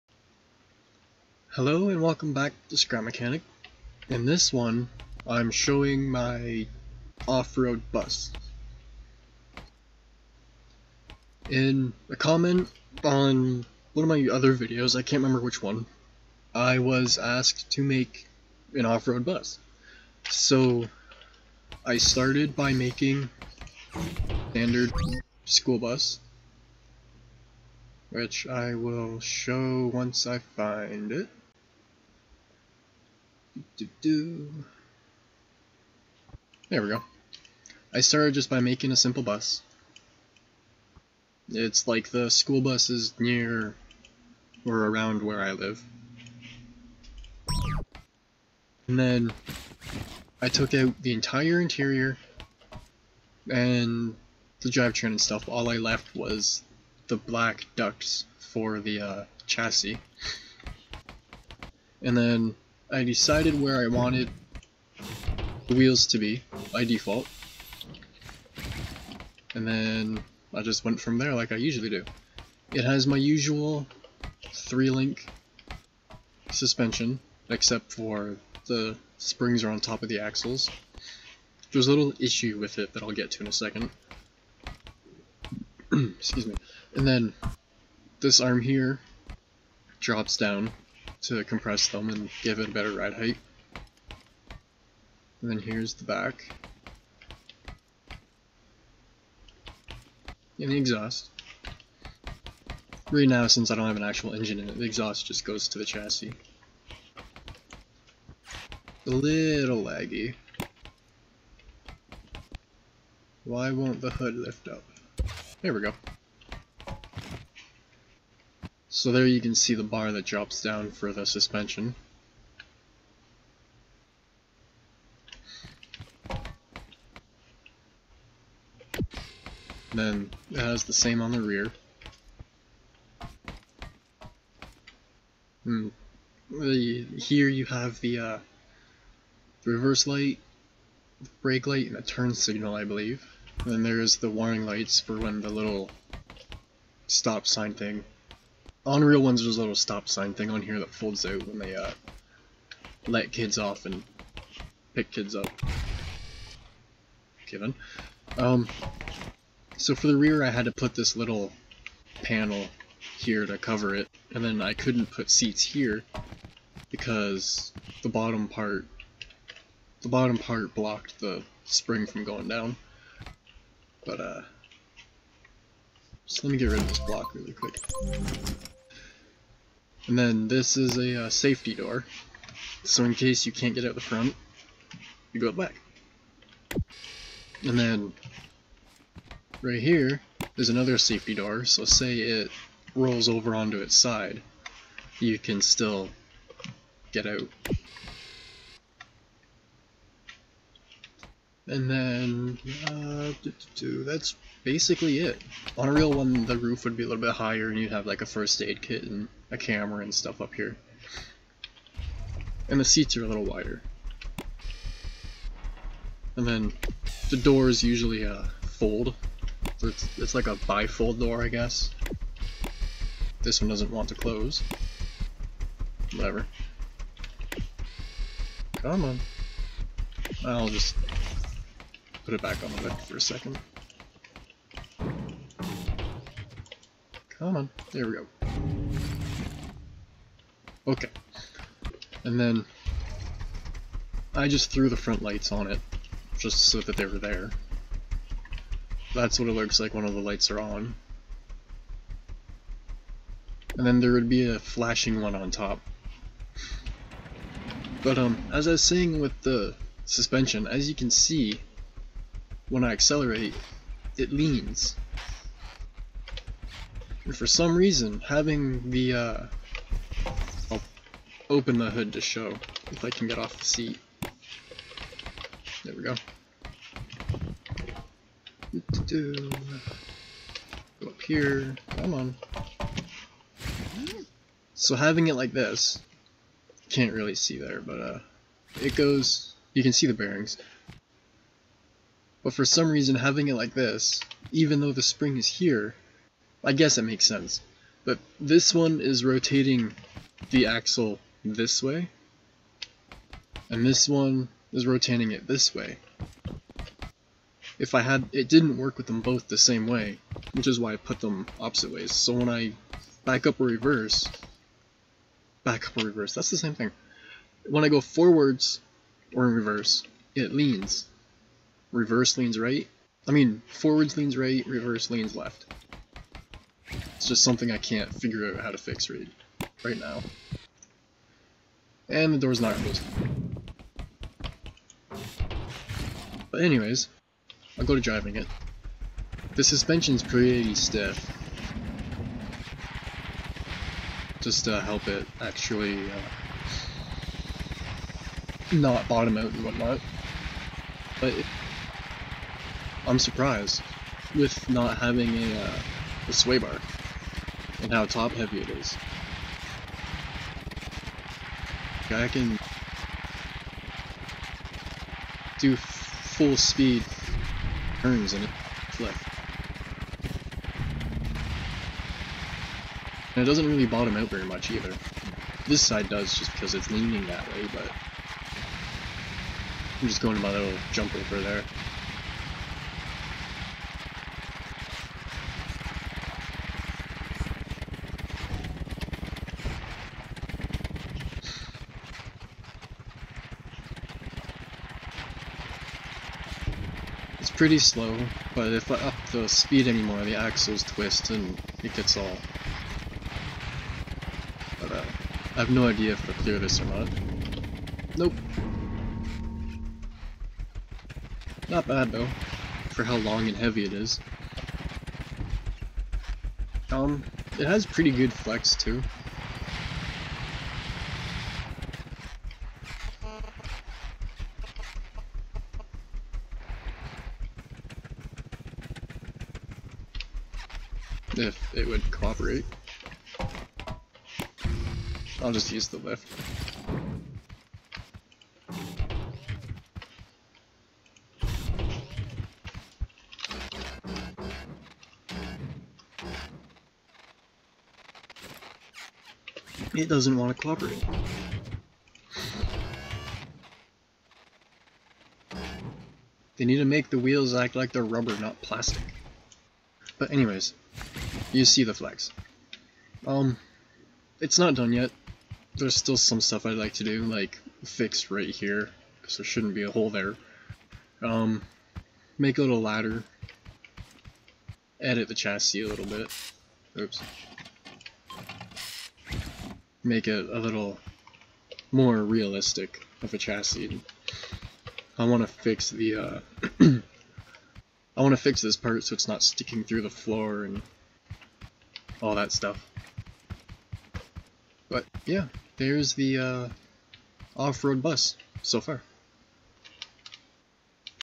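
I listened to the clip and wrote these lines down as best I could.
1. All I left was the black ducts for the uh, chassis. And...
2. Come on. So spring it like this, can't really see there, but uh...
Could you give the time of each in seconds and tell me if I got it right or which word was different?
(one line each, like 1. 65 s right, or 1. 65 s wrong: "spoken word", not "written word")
1. 55 s right
2. 281 s wrong: "having", not "spring".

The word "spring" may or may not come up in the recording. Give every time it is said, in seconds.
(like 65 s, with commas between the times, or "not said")
79 s, 171 s, 295 s.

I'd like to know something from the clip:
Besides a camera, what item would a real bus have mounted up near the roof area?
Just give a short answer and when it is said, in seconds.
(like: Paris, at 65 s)
first aid kit, at 208 s.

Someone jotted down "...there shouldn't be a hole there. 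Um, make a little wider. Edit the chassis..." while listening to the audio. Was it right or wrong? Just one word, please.
wrong.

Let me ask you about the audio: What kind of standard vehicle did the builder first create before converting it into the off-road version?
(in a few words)
school bus.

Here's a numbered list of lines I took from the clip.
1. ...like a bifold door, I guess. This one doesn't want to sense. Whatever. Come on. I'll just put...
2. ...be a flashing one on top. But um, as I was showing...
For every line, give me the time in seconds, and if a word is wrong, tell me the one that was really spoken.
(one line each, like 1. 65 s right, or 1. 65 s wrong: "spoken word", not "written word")
1. 220 s wrong: "close", not "sense"
2. 254 s wrong: "saying", not "showing".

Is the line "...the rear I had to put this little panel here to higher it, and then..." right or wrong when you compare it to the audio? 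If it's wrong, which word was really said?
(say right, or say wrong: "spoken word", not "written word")
wrong: "cover", not "higher".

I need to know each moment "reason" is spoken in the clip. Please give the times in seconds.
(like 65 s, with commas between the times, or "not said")
267 s, 292 s.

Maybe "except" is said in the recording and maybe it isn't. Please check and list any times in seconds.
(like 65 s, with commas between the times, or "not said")
77 s.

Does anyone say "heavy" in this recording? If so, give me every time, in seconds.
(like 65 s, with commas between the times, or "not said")
358 s, 413 s.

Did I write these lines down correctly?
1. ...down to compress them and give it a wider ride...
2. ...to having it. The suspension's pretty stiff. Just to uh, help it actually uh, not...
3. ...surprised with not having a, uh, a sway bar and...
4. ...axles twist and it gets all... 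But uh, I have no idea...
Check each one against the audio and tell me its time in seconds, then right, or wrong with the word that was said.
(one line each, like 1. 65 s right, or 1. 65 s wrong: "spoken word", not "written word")
1. 90 s wrong: "better", not "wider"
2. 337 s wrong: "driving", not "having"
3. 353 s right
4. 400 s right.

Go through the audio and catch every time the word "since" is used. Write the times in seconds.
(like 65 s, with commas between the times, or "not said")
103 s.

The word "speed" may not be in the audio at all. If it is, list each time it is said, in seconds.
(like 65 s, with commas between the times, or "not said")
366 s, 399 s.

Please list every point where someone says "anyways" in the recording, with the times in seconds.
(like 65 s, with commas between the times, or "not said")
336 s, 460 s.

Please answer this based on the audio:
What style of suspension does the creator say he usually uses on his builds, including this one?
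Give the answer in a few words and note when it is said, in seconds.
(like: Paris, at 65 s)
three-link suspension, at 74 s.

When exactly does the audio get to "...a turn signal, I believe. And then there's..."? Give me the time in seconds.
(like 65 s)
141 s.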